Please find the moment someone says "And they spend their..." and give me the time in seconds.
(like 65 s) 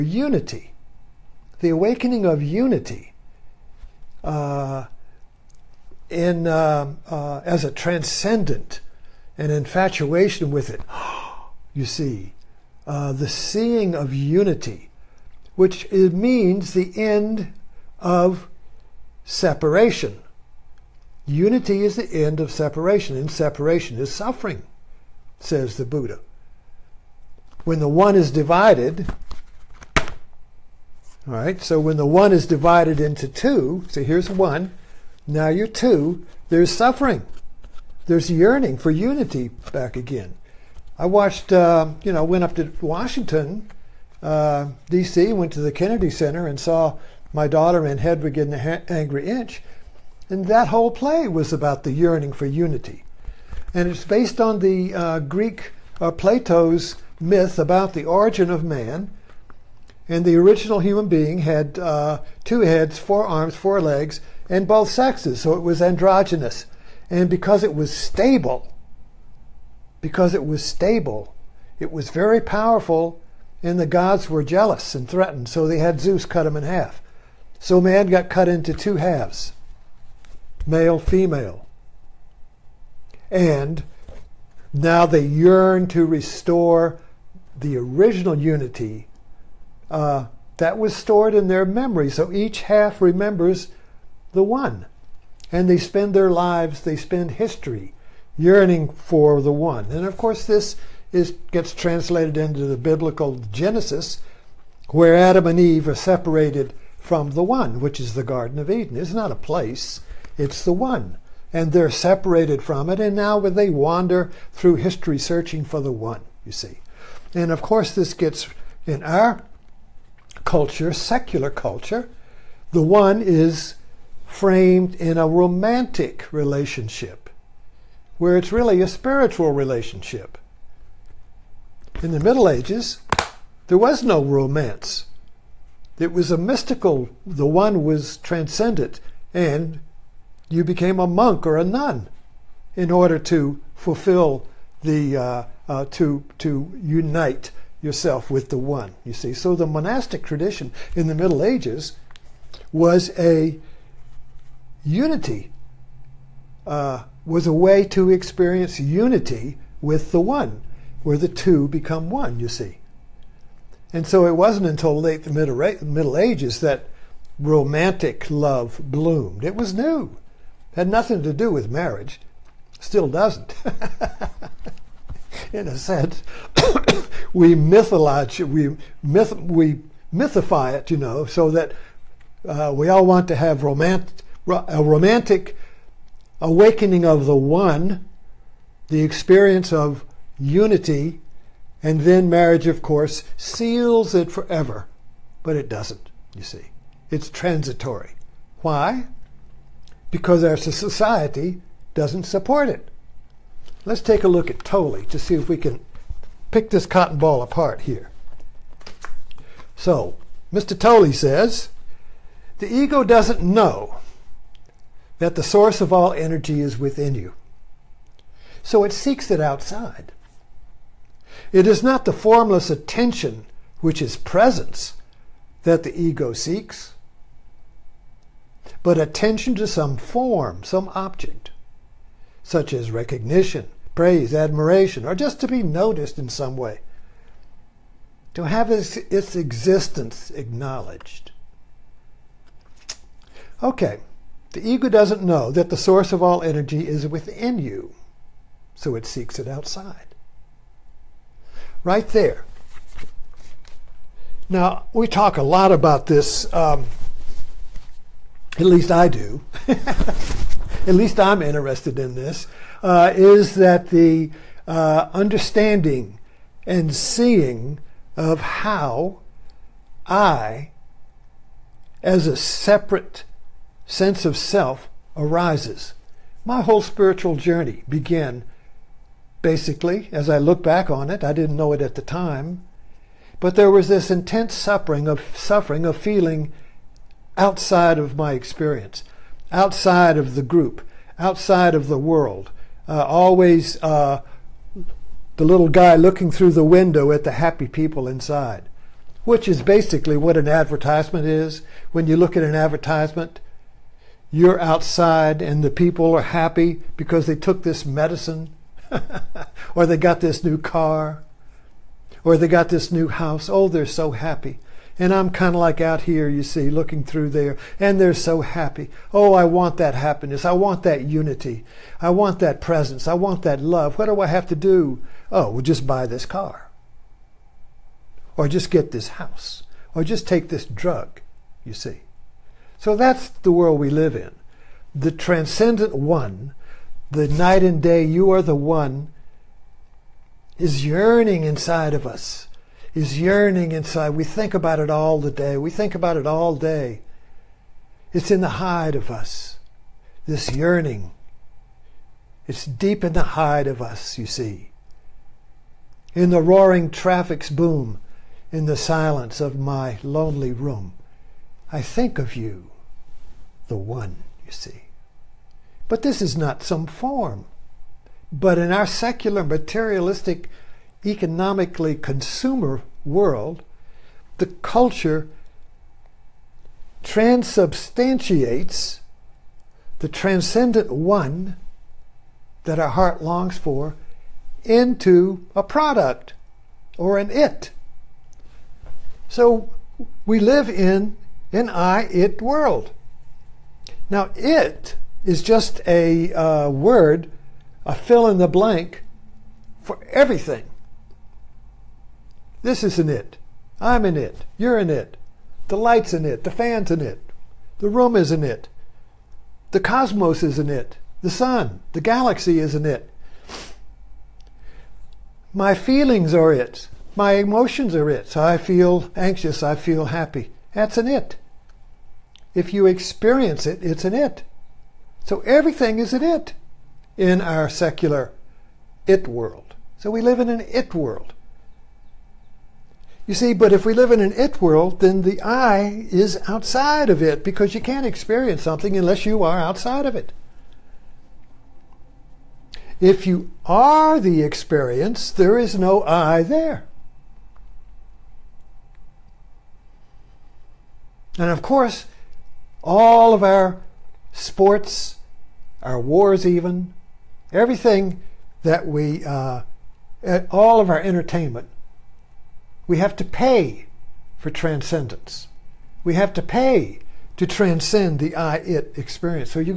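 95 s.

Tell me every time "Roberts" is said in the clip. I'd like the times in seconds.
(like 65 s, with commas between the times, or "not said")
not said.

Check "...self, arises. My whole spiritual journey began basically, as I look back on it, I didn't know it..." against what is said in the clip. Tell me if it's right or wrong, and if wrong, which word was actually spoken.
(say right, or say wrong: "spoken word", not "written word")
right.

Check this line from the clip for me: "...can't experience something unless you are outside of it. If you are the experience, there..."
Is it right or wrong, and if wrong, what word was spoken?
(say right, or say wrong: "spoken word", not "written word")
right.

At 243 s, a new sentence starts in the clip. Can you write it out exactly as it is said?
Okay, the ego doesn't know that the source of all energy is within you, so it seeks it outside.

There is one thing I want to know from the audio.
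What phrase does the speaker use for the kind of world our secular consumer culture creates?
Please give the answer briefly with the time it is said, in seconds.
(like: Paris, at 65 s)
I it world, at 391 s.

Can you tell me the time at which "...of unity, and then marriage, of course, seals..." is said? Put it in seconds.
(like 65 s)
189 s.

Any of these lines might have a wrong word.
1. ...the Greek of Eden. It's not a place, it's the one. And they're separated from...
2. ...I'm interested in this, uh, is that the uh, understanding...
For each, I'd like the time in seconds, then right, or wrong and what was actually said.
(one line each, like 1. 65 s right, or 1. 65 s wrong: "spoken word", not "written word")
1. 108 s wrong: "Garden", not "Greek"
2. 261 s right.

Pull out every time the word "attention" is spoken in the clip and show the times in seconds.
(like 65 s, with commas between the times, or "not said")
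222 s, 228 s.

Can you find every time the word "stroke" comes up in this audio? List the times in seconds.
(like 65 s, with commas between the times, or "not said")
not said.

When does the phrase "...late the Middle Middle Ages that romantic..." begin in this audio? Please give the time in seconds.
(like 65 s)
165 s.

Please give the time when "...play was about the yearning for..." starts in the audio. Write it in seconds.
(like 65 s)
50 s.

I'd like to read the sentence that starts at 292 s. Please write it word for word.
Uh, always uh, the little guy looking through the window at the happy people inside, which is basically what an advertisement is.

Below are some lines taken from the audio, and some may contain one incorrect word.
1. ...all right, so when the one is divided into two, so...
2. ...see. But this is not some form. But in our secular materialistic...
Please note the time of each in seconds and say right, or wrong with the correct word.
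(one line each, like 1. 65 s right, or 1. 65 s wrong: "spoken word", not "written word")
1. 29 s right
2. 364 s right.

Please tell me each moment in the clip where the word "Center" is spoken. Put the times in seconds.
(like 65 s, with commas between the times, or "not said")
46 s.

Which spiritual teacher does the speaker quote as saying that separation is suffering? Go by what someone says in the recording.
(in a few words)
The Buddha.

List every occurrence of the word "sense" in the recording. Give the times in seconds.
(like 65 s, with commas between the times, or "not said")
175 s, 273 s.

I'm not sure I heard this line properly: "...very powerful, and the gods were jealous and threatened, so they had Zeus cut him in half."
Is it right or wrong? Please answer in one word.
right.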